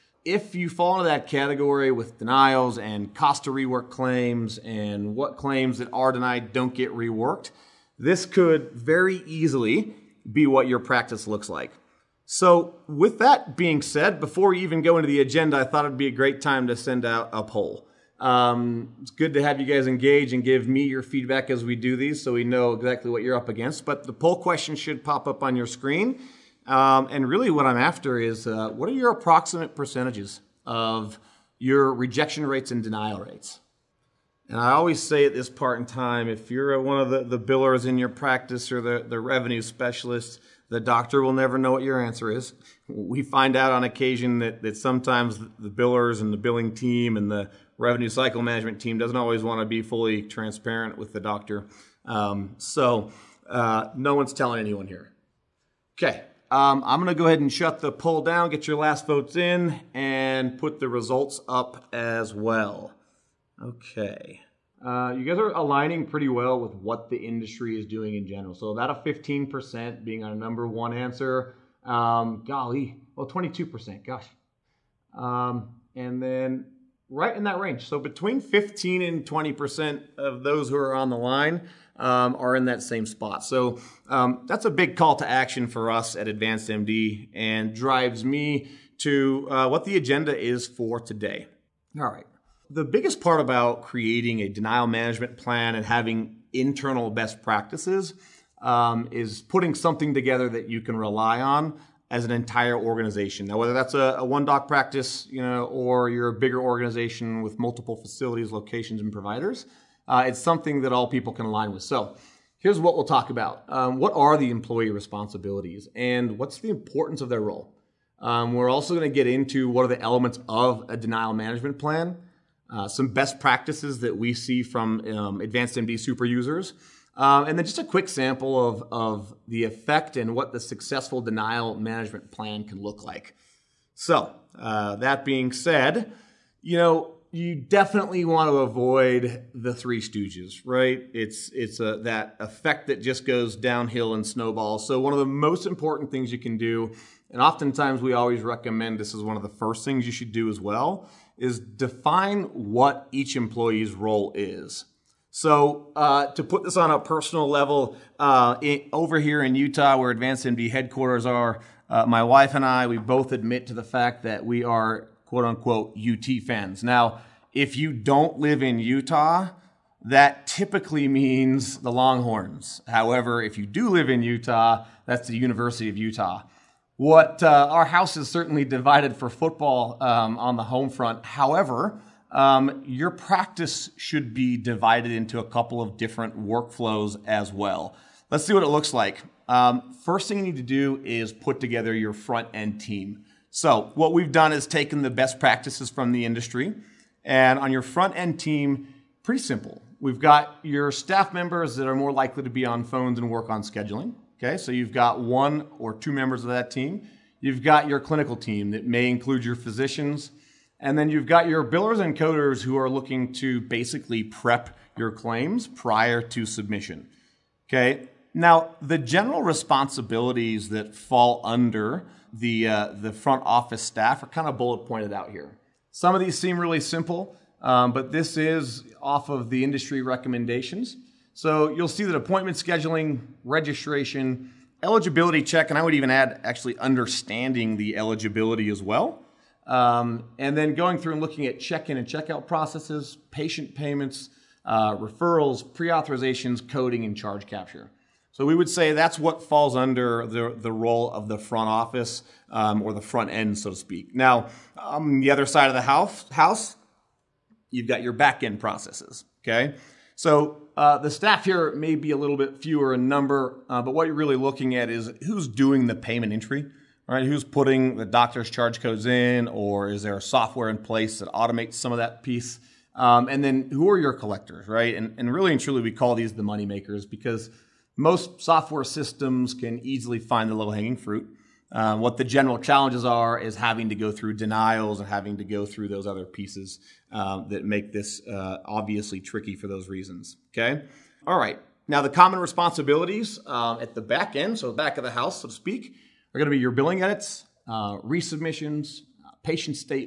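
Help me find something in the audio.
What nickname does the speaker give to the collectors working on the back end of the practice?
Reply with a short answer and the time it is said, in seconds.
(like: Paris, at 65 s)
the money makers, at 276 s.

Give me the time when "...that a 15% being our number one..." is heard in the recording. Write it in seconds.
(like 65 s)
68 s.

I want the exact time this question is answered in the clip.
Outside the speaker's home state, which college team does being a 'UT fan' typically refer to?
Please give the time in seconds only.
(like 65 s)
171 s.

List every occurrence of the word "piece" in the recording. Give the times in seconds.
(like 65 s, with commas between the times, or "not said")
272 s, 286 s.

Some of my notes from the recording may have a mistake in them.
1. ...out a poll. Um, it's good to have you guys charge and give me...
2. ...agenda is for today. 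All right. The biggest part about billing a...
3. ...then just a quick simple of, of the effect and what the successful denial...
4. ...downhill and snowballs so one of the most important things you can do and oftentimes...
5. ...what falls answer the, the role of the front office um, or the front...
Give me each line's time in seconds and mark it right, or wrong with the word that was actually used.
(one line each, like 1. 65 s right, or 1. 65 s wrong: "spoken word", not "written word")
1. 17 s wrong: "engage", not "charge"
2. 89 s wrong: "creating", not "billing"
3. 127 s wrong: "sample", not "simple"
4. 143 s right
5. 249 s wrong: "under", not "answer".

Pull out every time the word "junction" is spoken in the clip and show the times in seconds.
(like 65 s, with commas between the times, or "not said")
not said.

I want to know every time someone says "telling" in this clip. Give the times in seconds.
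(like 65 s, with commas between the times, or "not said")
54 s.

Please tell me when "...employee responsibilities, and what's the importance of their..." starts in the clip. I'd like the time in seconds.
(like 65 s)
114 s.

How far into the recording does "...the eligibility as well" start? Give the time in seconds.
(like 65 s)
237 s.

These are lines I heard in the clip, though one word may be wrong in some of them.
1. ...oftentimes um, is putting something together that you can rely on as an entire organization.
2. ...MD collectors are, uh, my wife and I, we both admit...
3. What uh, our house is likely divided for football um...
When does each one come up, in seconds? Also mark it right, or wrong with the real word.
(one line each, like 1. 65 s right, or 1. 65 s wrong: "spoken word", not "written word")
1. 97 s wrong: "practices", not "oftentimes"
2. 160 s wrong: "headquarters", not "collectors"
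3. 176 s wrong: "certainly", not "likely".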